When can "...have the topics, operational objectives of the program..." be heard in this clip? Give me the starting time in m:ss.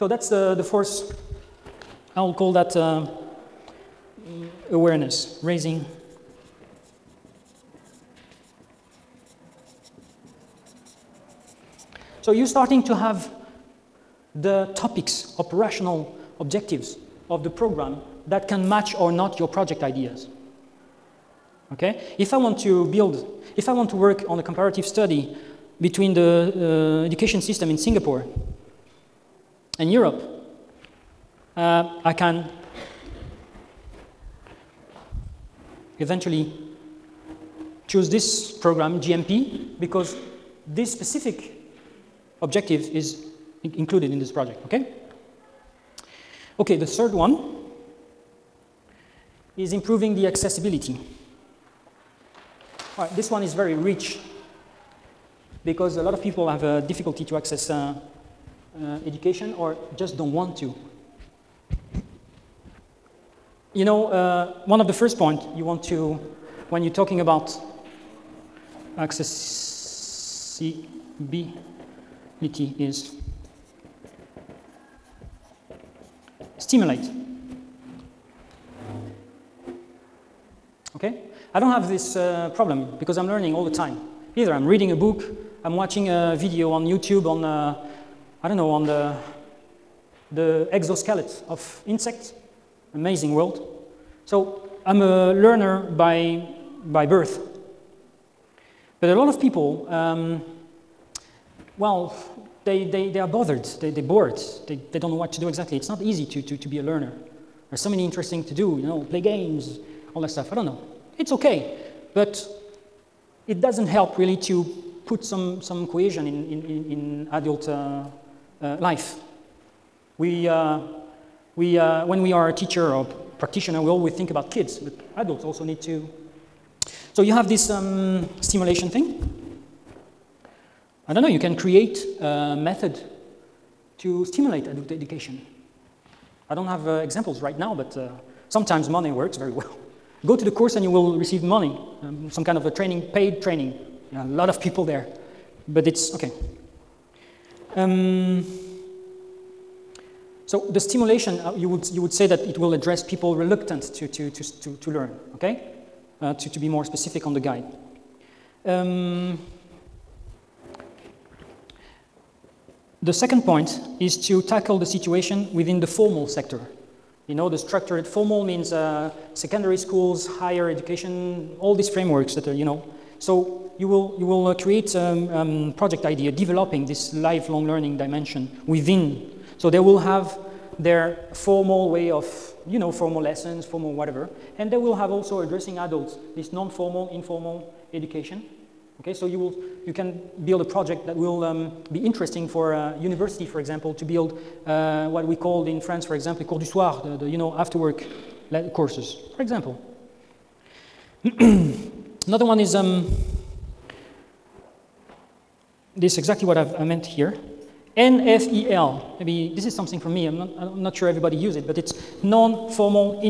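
0:12.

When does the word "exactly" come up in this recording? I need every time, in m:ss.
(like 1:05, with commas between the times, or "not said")
1:45, 3:26.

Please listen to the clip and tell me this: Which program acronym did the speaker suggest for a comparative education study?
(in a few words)
GMP.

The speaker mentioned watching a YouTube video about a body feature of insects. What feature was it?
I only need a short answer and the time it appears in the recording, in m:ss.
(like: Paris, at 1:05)
exoskeleton, at 1:30.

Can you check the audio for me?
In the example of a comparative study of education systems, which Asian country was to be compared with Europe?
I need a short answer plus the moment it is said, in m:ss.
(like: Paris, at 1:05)
Singapore, at 0:27.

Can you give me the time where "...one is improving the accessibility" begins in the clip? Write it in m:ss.
0:47.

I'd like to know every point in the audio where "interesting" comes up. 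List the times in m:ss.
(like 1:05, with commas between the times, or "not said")
1:48, 3:11.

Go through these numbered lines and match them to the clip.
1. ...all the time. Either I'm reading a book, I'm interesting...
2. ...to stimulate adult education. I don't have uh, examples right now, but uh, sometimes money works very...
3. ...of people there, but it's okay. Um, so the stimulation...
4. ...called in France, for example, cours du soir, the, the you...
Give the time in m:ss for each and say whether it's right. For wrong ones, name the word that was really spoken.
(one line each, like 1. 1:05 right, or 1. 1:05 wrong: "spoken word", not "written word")
1. 1:23 wrong: "watching", not "interesting"
2. 2:13 right
3. 2:24 right
4. 3:15 right.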